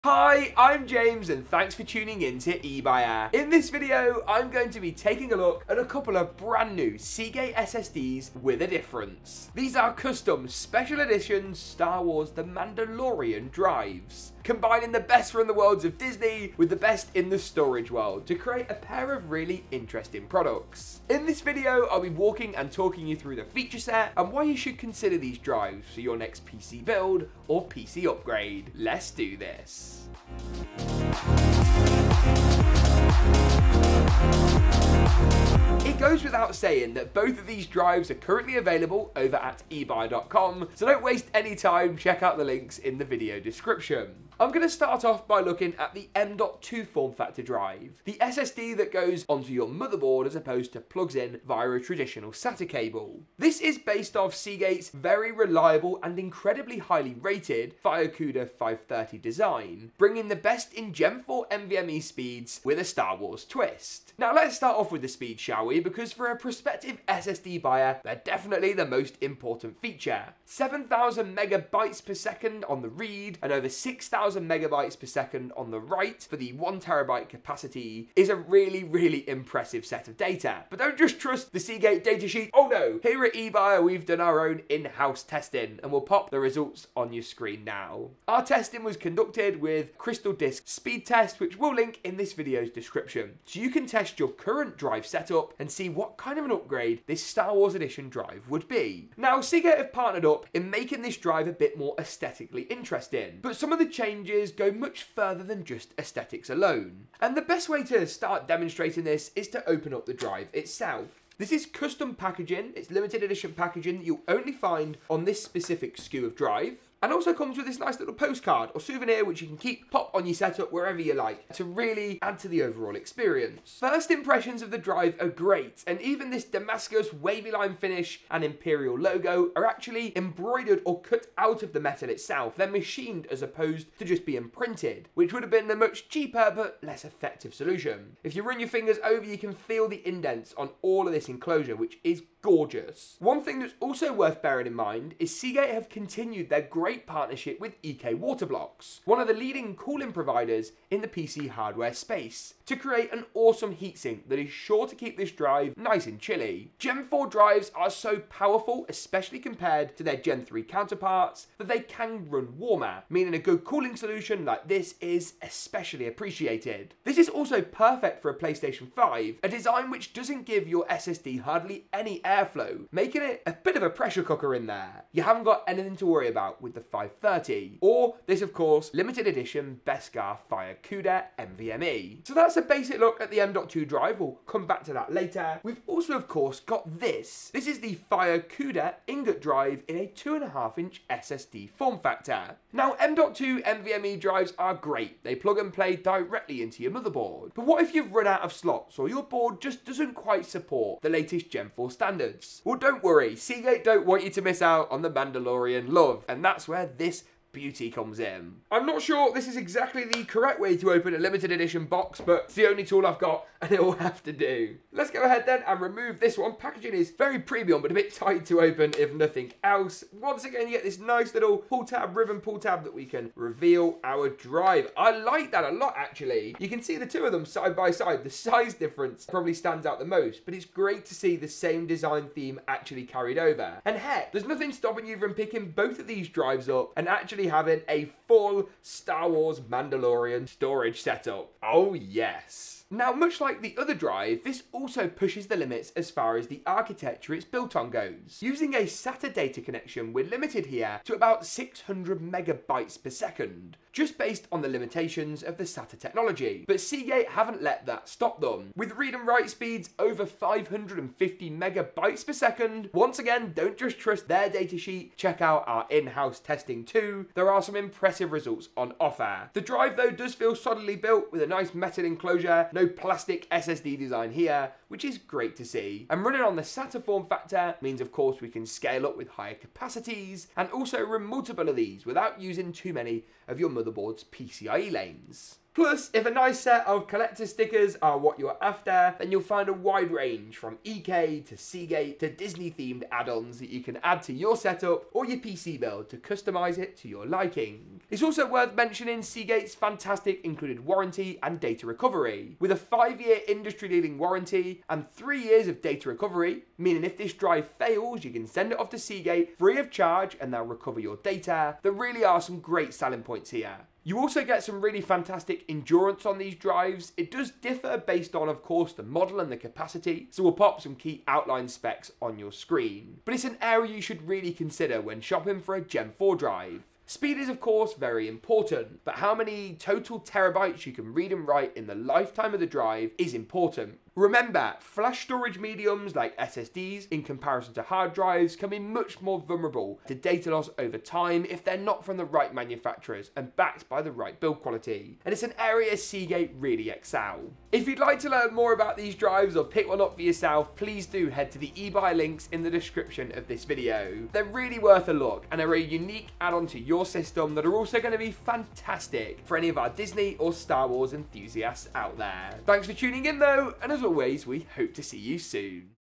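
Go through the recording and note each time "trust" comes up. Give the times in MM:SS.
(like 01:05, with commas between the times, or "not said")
01:21, 04:23.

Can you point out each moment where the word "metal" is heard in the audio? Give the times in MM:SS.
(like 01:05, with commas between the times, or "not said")
02:11, 04:31.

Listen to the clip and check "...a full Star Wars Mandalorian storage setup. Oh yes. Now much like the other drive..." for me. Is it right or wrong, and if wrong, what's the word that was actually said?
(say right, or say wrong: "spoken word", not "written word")
right.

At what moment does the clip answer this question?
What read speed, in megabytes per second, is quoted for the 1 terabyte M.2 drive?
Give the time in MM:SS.
01:10.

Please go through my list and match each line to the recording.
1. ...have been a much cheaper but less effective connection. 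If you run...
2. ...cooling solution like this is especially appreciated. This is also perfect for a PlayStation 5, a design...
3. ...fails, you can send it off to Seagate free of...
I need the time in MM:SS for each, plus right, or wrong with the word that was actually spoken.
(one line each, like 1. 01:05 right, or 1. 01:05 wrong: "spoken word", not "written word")
1. 02:15 wrong: "solution", not "connection"
2. 02:43 right
3. 05:07 right.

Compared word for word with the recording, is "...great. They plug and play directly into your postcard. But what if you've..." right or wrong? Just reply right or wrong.
wrong.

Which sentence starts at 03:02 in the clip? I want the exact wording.
So that's a basic look at the M.2 drive.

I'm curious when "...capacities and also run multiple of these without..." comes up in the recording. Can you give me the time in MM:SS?
04:39.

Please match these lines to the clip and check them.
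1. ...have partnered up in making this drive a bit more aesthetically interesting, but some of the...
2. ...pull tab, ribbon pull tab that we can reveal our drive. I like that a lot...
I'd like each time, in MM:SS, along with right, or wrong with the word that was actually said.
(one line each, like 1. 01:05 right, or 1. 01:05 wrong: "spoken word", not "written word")
1. 01:39 right
2. 03:41 right.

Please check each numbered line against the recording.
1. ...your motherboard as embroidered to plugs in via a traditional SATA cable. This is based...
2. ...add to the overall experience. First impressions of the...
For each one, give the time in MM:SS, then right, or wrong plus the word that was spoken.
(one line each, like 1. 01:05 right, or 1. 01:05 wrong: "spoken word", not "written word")
1. 00:49 wrong: "opposed", not "embroidered"
2. 02:02 right.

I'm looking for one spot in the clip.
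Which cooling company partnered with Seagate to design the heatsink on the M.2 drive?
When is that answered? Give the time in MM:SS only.
02:27.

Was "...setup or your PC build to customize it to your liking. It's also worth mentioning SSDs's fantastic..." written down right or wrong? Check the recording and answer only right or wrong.
wrong.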